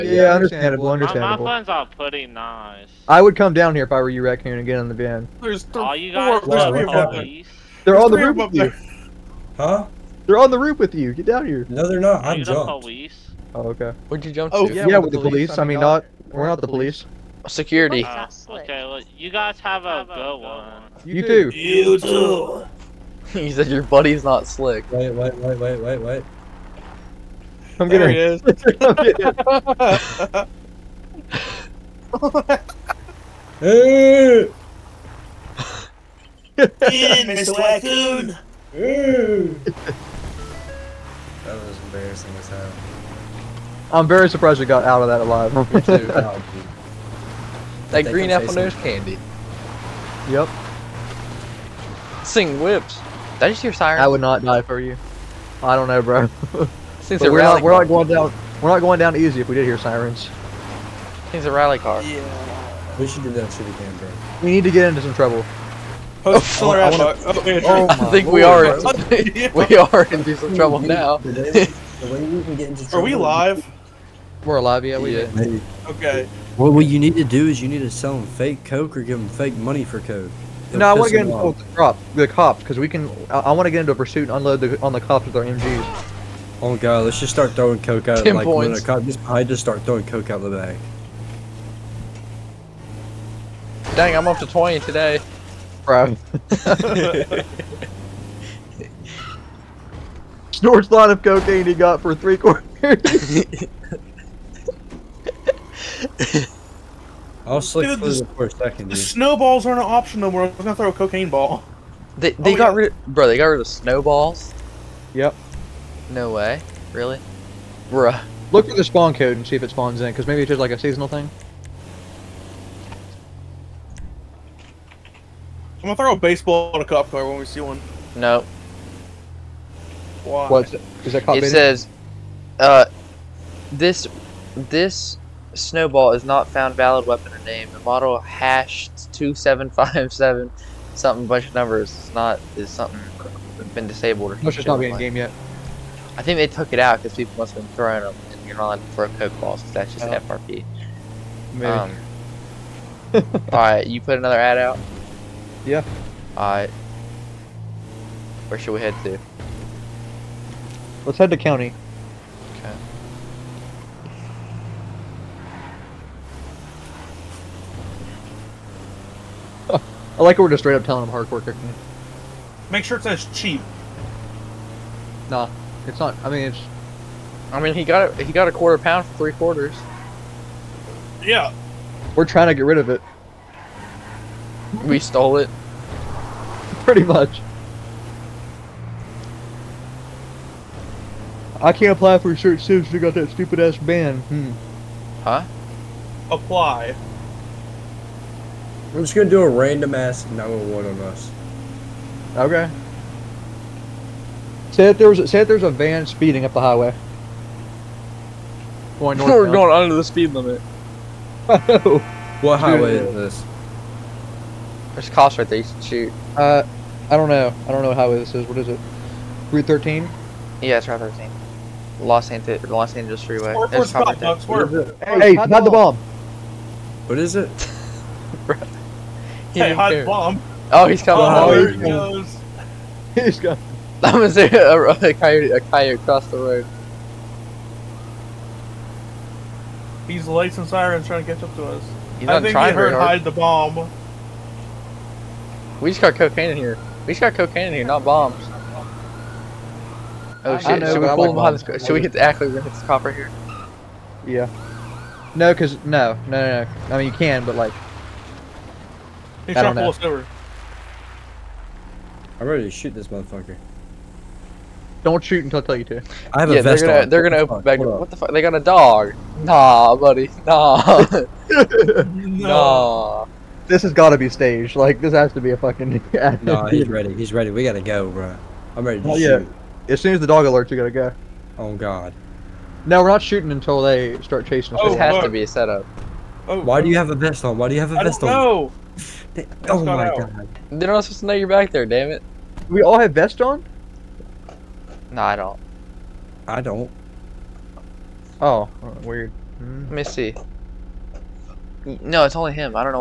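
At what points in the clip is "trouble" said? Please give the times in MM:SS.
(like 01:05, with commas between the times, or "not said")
01:05, 01:10.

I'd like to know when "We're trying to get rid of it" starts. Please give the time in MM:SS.
03:02.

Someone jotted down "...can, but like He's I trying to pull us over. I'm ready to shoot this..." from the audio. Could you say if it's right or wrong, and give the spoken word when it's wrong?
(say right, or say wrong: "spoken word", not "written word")
right.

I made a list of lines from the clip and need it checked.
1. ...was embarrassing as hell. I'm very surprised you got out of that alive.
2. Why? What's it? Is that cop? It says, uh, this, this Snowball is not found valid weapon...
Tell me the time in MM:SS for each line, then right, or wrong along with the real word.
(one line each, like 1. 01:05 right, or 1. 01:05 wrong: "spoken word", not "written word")
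1. 00:41 right
2. 02:10 right.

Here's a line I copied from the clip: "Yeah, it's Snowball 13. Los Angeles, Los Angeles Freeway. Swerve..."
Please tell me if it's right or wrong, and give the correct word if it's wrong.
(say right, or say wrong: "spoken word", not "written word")
wrong: "Route", not "Snowball".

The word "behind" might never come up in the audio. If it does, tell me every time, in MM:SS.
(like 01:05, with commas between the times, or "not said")
04:11.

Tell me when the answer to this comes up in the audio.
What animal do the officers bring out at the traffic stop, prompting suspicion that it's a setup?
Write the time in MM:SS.
04:28.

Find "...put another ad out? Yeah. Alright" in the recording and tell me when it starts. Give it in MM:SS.
02:33.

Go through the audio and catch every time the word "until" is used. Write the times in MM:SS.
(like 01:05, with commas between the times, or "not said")
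04:25, 04:43.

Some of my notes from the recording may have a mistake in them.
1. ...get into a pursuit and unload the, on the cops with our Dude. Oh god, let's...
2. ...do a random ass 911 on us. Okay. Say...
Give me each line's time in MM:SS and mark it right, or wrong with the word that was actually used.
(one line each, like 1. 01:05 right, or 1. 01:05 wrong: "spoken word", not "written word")
1. 01:23 wrong: "MGs", not "Dude"
2. 03:19 right.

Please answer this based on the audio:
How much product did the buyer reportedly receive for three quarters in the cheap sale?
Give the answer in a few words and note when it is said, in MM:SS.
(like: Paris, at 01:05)
A quarter pound, at 02:58.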